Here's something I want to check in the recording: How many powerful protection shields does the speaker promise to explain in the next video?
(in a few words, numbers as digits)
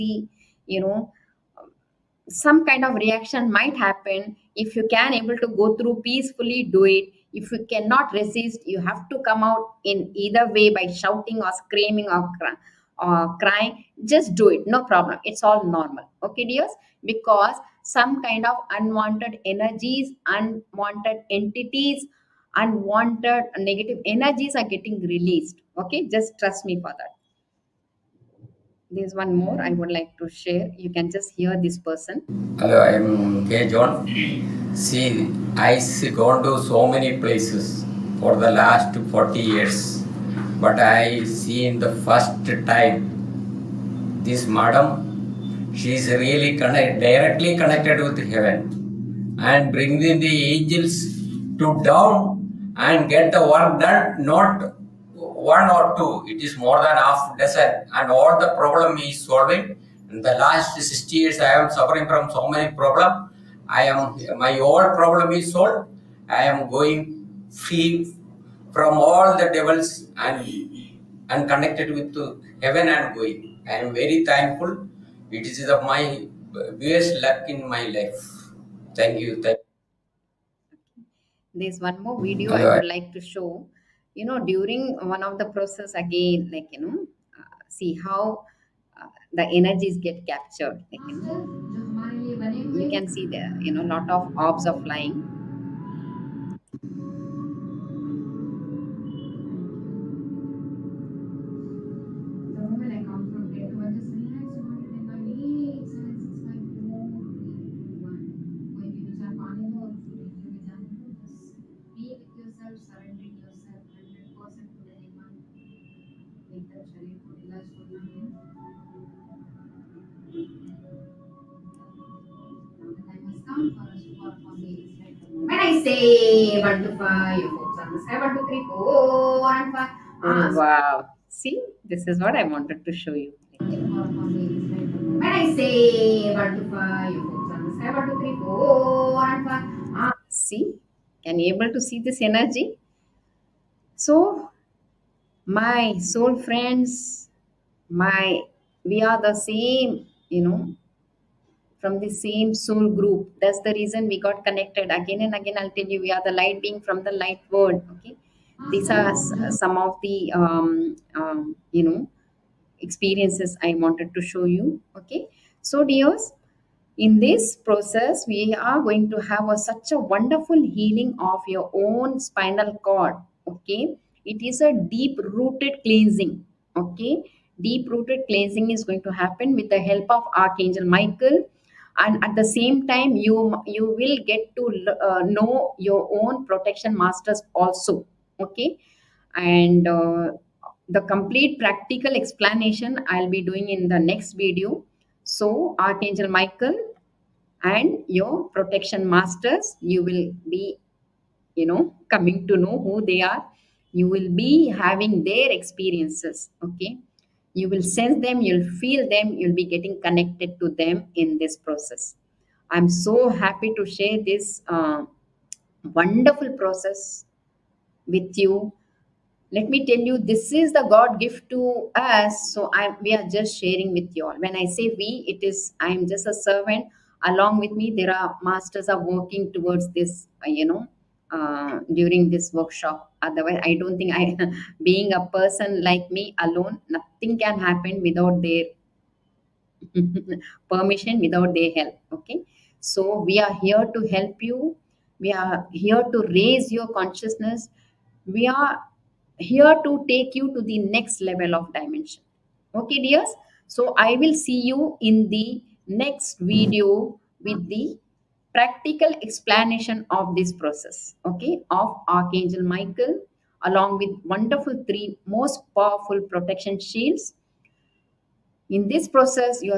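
3.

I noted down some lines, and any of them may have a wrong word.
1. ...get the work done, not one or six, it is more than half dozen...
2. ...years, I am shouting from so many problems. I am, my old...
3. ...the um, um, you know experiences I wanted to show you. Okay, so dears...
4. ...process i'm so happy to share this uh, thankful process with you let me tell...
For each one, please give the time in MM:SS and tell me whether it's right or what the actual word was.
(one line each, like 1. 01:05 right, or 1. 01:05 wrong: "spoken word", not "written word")
1. 00:53 wrong: "two", not "six"
2. 01:01 wrong: "suffering", not "shouting"
3. 02:40 right
4. 03:31 wrong: "wonderful", not "thankful".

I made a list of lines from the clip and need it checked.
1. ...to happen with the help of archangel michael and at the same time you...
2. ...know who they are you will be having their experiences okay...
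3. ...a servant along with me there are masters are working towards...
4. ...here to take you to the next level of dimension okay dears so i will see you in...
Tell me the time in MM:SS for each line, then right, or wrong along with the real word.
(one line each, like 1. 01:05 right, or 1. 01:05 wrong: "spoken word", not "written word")
1. 02:59 right
2. 03:22 right
3. 03:46 right
4. 04:09 right.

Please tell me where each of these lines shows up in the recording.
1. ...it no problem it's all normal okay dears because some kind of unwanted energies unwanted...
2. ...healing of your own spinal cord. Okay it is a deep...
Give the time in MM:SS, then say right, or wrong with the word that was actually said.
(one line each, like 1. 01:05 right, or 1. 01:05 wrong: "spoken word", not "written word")
1. 00:14 right
2. 02:50 right.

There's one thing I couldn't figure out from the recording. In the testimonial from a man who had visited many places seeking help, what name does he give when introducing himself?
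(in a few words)
K John.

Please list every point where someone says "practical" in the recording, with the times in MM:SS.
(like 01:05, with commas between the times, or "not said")
03:11, 04:18.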